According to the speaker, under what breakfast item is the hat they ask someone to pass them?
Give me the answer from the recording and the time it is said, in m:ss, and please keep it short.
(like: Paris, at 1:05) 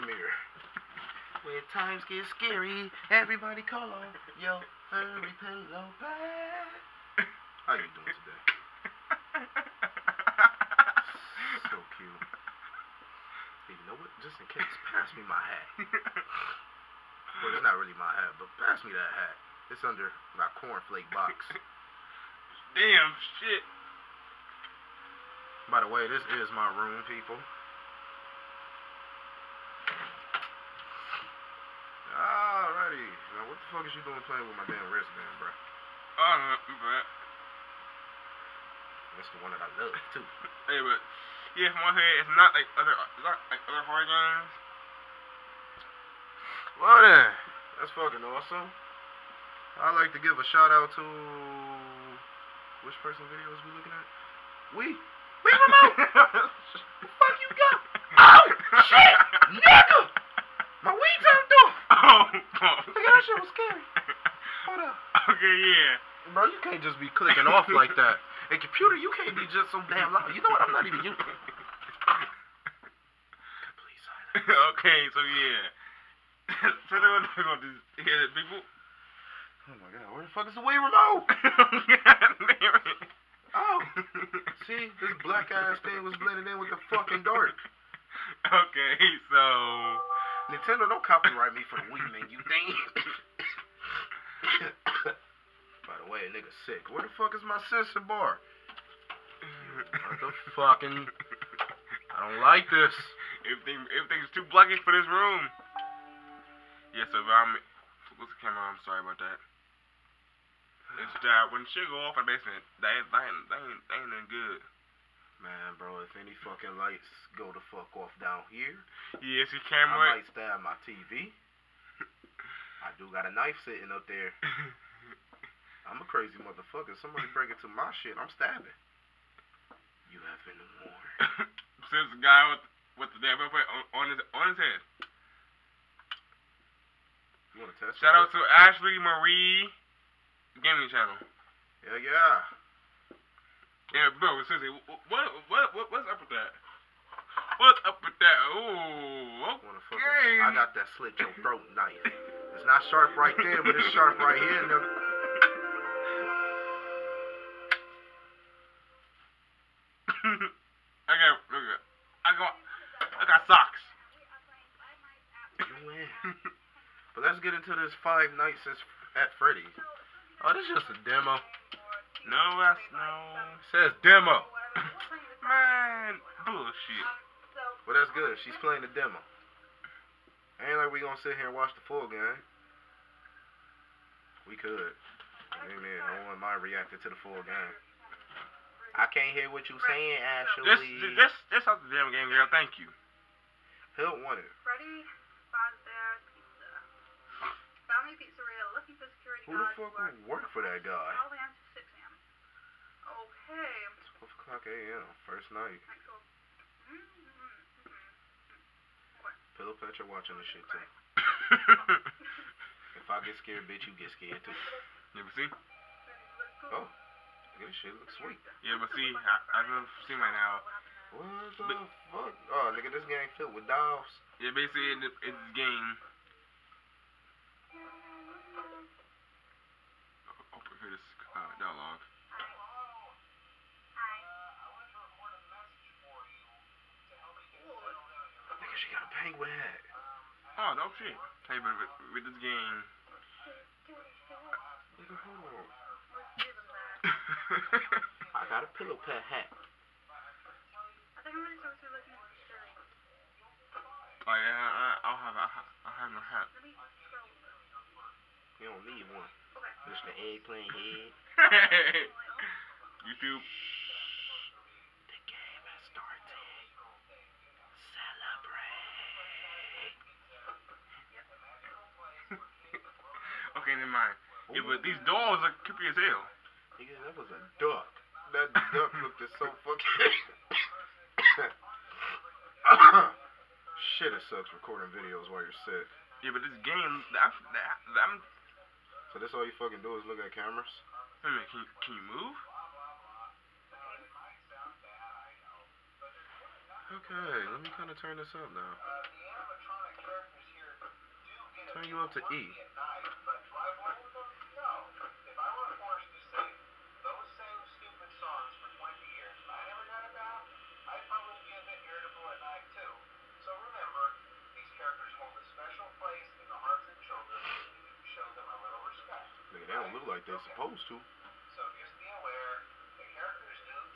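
Cornflake box, at 0:20.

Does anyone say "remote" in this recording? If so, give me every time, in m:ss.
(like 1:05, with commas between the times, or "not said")
0:55, 1:20.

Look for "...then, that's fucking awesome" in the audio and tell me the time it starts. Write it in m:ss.
0:47.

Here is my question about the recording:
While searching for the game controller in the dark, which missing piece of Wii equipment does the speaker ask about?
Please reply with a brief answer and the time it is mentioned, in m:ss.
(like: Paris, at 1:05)
Sensor bar, at 1:37.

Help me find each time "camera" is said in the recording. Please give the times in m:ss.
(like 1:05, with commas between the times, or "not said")
1:48, 1:59, 4:50.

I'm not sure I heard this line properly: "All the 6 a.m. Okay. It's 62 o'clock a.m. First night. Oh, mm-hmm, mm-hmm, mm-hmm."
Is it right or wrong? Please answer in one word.
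wrong.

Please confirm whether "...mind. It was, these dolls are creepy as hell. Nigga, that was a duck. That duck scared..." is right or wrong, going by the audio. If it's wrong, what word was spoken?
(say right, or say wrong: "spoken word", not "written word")
wrong: "looked", not "scared".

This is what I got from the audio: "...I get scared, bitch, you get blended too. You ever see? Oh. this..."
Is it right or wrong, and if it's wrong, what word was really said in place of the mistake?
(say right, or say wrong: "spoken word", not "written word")
wrong: "scared", not "blended".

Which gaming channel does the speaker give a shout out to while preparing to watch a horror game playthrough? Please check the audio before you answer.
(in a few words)
Ashley Marie Gaming Channel.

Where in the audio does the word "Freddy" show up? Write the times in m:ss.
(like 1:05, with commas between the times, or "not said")
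2:49, 3:14.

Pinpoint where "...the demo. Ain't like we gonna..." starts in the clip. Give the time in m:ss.
2:58.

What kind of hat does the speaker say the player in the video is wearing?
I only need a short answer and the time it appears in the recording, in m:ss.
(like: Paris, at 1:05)
Penguin hat, at 3:59.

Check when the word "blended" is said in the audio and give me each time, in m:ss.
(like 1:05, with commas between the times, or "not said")
1:26.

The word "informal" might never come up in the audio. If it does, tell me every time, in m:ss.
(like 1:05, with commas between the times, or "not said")
not said.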